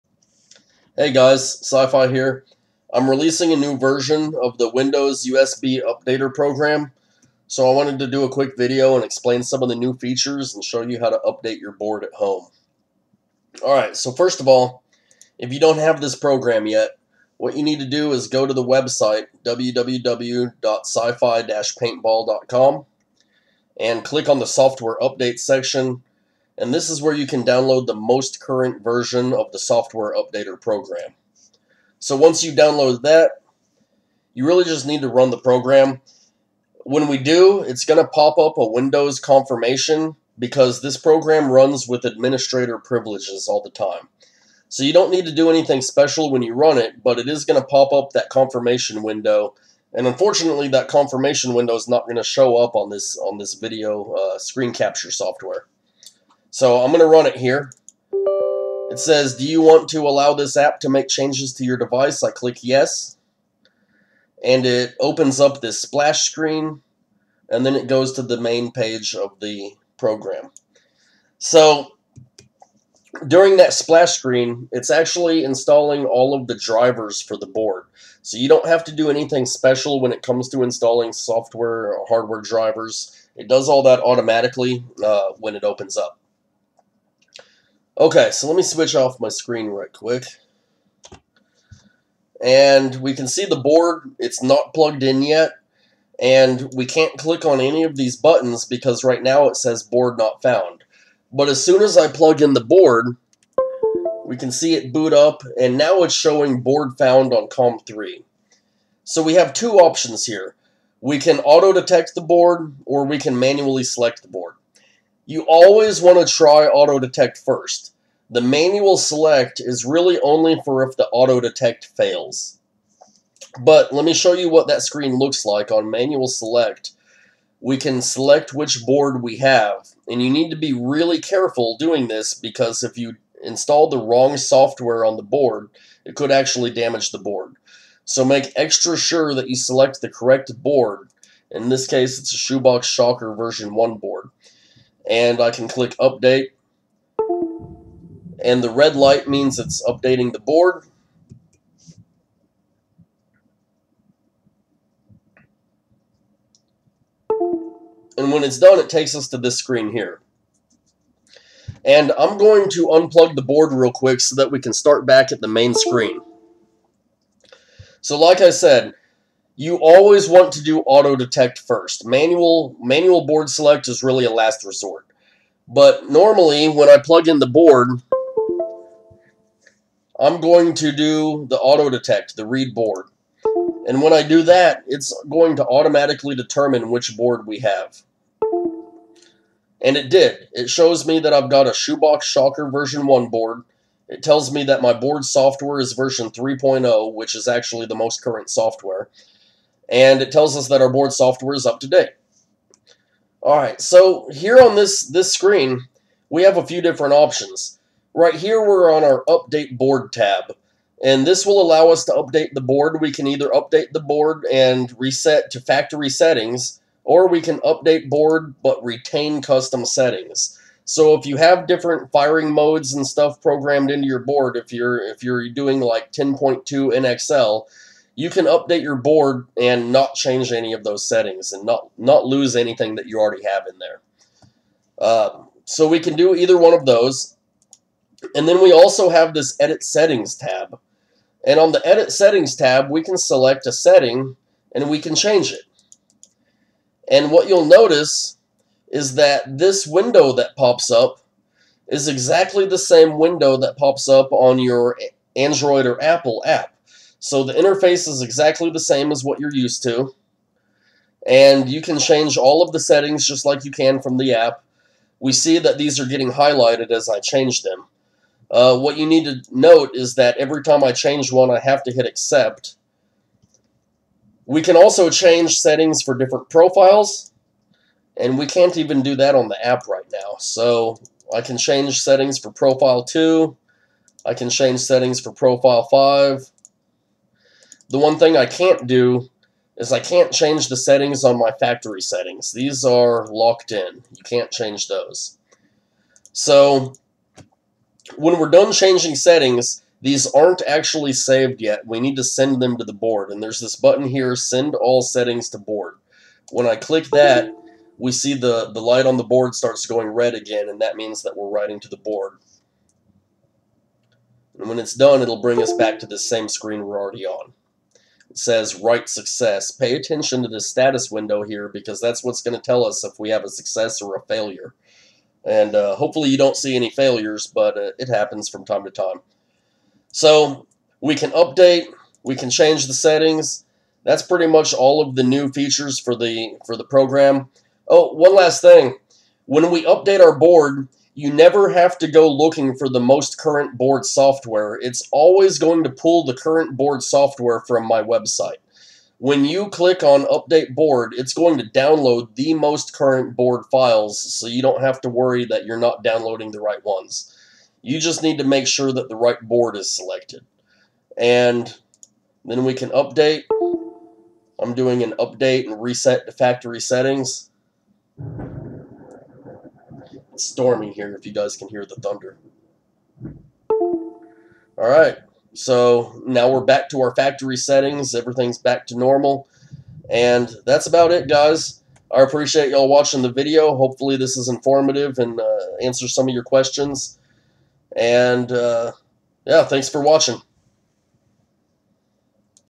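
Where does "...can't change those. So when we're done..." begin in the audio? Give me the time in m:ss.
4:54.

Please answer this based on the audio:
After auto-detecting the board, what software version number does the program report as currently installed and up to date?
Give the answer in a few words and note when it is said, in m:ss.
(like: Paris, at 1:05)
3.0, at 3:16.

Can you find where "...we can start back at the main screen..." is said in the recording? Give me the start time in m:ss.
2:44.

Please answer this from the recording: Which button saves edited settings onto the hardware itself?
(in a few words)
Send All Settings to Board.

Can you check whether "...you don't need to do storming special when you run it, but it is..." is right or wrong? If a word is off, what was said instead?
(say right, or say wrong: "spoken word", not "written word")
wrong: "anything", not "storming".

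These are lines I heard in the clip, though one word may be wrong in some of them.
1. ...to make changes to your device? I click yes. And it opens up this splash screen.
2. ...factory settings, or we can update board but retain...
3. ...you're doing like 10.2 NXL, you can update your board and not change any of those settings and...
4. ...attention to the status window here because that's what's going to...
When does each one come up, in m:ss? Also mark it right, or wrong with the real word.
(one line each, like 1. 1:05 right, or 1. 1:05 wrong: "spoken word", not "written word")
1. 1:00 right
2. 3:35 right
3. 3:45 right
4. 5:19 right.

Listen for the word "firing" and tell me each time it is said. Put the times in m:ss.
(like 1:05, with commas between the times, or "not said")
3:42.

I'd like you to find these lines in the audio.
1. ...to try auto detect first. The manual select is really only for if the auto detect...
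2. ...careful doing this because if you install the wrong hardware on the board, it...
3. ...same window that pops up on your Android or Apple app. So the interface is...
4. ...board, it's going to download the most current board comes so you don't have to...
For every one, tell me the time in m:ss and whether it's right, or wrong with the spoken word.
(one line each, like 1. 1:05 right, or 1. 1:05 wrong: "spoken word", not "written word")
1. 1:56 right
2. 2:11 wrong: "software", not "hardware"
3. 4:12 right
4. 5:50 wrong: "files", not "comes".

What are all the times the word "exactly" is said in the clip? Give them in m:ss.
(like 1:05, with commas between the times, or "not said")
4:12, 4:18.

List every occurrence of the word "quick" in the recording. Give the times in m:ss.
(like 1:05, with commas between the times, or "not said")
0:08, 1:29, 2:43.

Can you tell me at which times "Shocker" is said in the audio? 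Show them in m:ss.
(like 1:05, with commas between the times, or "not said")
2:22, 3:12.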